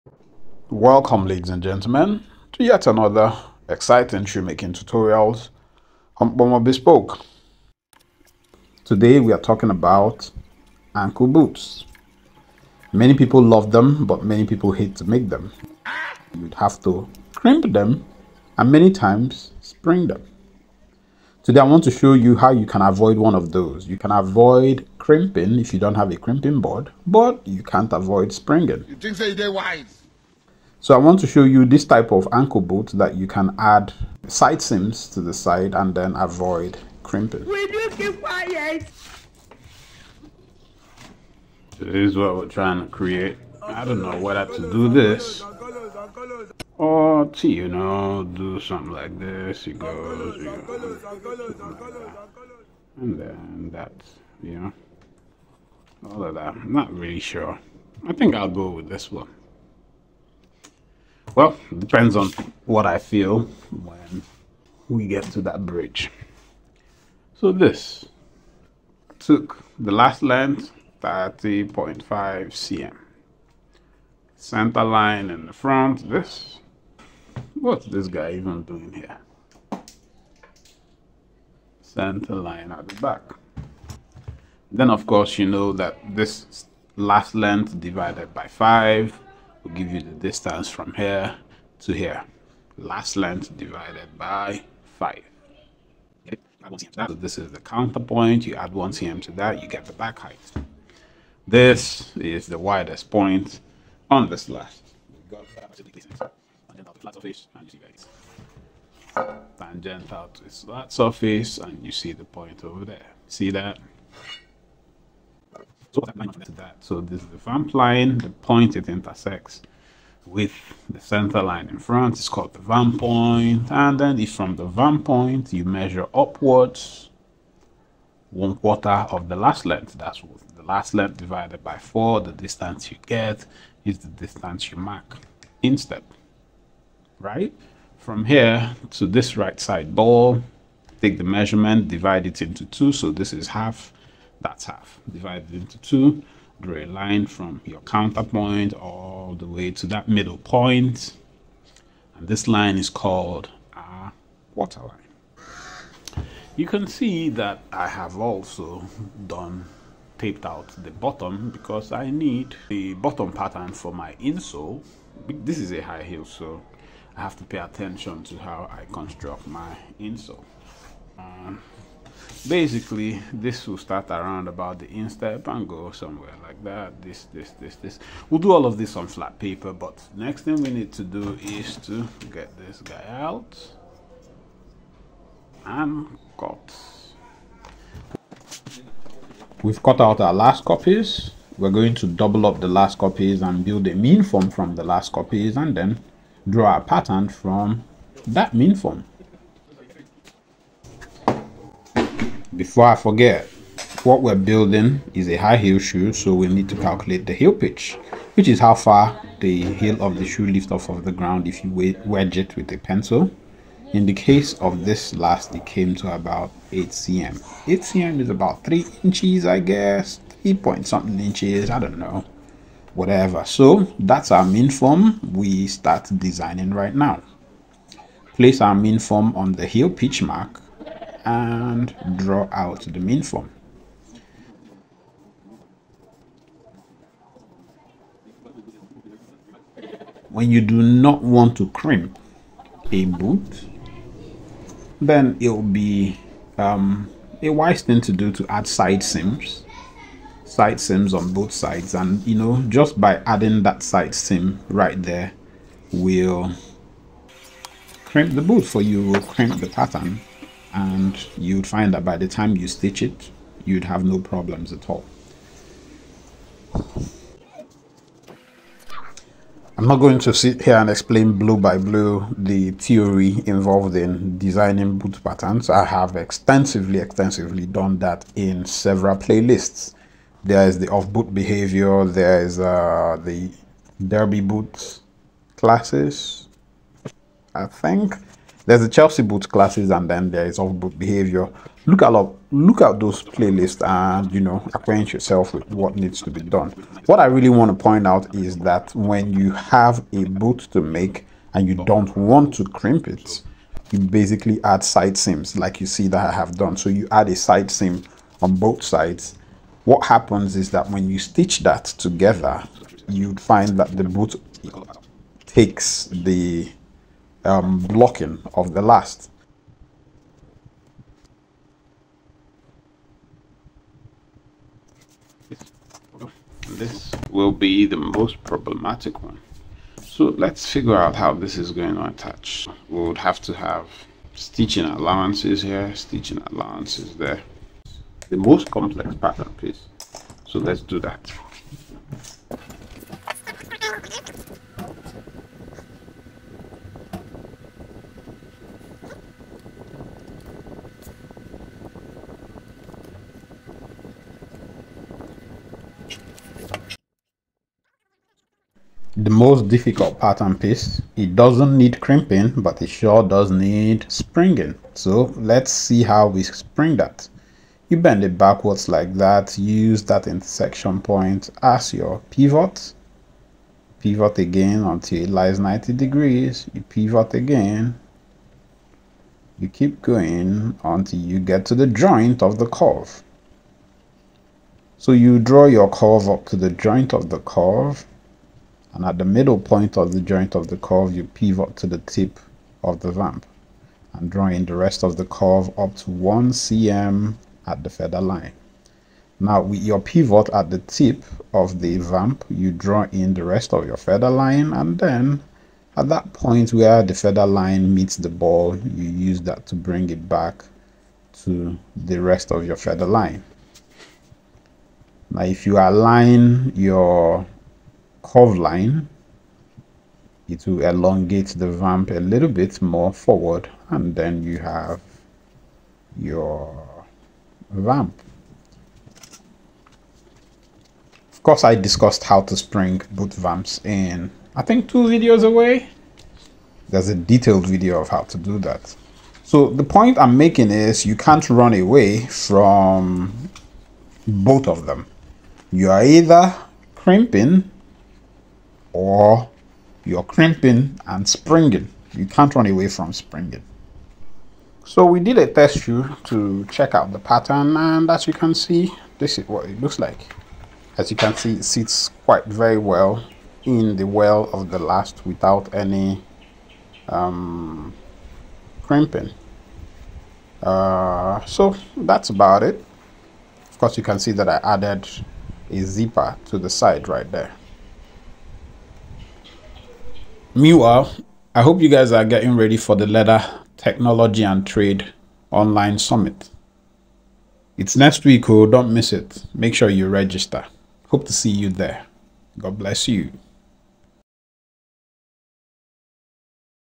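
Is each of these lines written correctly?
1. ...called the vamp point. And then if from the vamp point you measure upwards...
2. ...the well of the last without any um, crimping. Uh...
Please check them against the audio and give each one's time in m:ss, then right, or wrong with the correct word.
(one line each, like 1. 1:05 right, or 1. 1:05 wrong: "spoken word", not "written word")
1. 2:02 right
2. 7:43 right.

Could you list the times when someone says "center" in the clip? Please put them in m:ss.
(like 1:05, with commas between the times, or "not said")
1:14, 1:21, 2:00.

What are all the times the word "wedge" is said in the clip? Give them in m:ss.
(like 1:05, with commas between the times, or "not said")
3:32.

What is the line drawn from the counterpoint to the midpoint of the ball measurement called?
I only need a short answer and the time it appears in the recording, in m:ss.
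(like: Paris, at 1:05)
water line, at 2:34.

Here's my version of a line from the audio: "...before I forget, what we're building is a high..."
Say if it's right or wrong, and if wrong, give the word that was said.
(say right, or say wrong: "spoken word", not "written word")
right.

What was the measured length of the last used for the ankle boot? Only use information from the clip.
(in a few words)
30.5 cm.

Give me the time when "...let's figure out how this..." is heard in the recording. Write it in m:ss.
5:30.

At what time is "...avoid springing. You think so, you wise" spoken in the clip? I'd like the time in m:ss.
0:27.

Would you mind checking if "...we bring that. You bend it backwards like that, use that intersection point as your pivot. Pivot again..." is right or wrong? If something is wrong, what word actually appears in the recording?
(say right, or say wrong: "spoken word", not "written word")
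wrong: "spring", not "bring".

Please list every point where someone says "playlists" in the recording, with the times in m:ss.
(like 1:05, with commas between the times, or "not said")
4:39, 4:53.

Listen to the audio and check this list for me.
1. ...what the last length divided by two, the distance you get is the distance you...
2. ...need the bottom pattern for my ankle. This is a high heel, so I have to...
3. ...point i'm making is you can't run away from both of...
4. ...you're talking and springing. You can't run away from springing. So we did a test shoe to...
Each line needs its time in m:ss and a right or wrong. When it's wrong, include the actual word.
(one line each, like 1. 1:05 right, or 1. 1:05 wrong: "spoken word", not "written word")
1. 2:10 wrong: "four", not "two"
2. 2:42 wrong: "insole", not "ankle"
3. 7:19 right
4. 7:30 wrong: "crimping", not "talking".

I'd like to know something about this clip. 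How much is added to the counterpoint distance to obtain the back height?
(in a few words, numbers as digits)
1 cm.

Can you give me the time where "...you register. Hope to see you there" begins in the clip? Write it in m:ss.
8:09.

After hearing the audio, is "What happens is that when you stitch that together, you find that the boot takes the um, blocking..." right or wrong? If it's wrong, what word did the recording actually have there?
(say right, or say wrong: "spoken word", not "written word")
right.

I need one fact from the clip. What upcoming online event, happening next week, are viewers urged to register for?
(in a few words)
Leather Technology and Trade Online Summit.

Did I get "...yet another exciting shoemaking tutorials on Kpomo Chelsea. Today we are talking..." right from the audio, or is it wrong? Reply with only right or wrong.
wrong.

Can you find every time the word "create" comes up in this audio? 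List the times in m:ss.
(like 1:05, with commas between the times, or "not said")
0:42.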